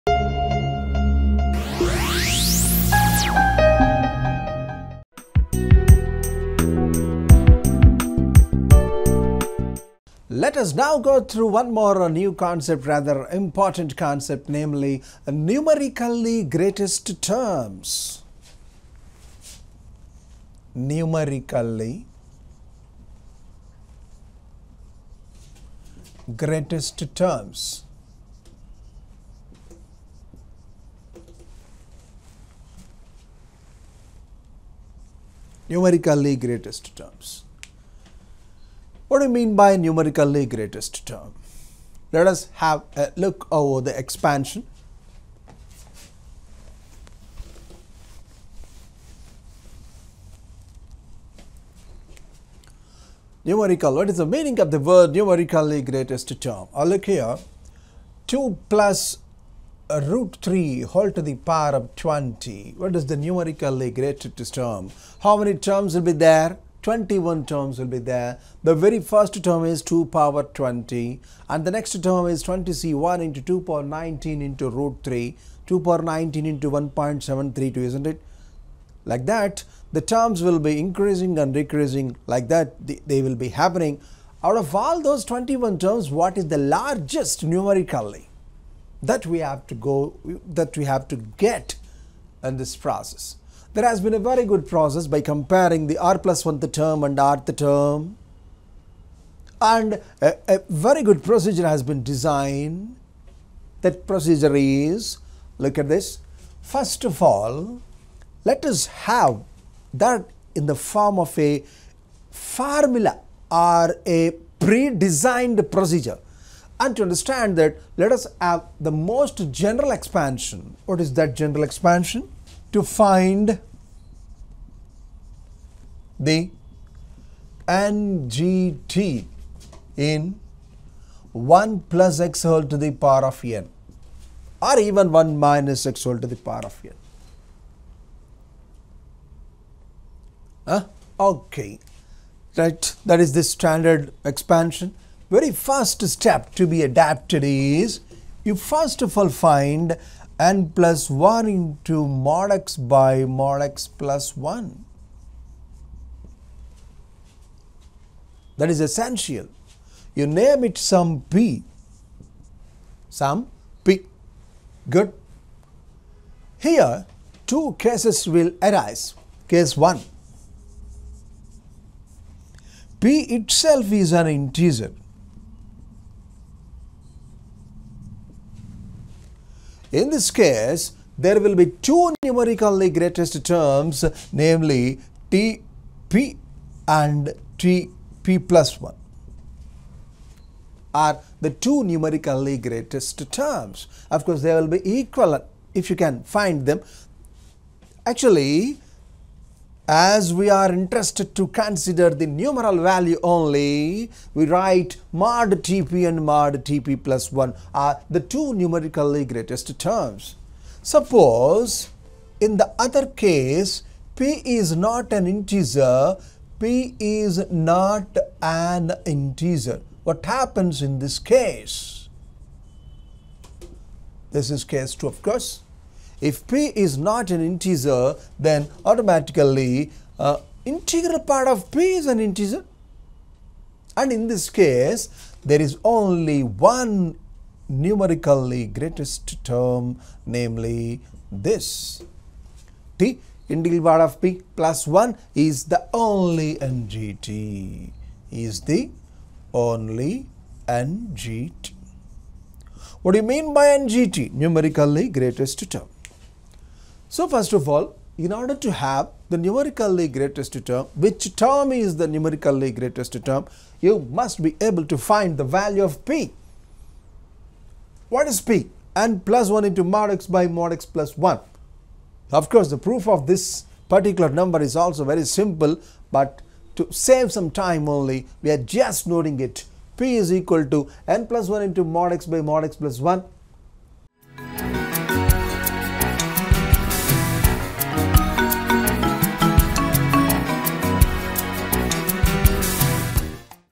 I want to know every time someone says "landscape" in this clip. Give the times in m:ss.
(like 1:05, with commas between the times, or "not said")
not said.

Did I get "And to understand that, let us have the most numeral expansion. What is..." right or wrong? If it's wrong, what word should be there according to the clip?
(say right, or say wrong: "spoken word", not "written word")
wrong: "general", not "numeral".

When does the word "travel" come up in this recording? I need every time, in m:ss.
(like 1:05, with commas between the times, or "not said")
not said.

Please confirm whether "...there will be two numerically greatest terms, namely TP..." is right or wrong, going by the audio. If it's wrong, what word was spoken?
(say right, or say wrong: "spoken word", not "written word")
right.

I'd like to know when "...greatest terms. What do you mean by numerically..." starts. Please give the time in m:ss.
0:36.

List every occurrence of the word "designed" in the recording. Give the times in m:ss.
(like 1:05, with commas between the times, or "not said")
1:42, 1:54.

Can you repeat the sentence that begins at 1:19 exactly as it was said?
Like that the terms will be increasing and decreasing like that they will be happening.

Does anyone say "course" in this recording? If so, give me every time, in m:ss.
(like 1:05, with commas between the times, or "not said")
3:14, 3:45, 4:32.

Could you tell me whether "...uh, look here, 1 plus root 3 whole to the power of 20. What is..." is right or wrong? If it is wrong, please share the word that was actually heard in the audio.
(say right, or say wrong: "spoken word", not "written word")
wrong: "2", not "1".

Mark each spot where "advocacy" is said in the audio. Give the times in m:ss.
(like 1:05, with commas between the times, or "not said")
not said.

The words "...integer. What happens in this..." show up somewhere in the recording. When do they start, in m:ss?
3:39.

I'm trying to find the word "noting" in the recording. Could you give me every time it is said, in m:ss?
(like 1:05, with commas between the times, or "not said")
4:39.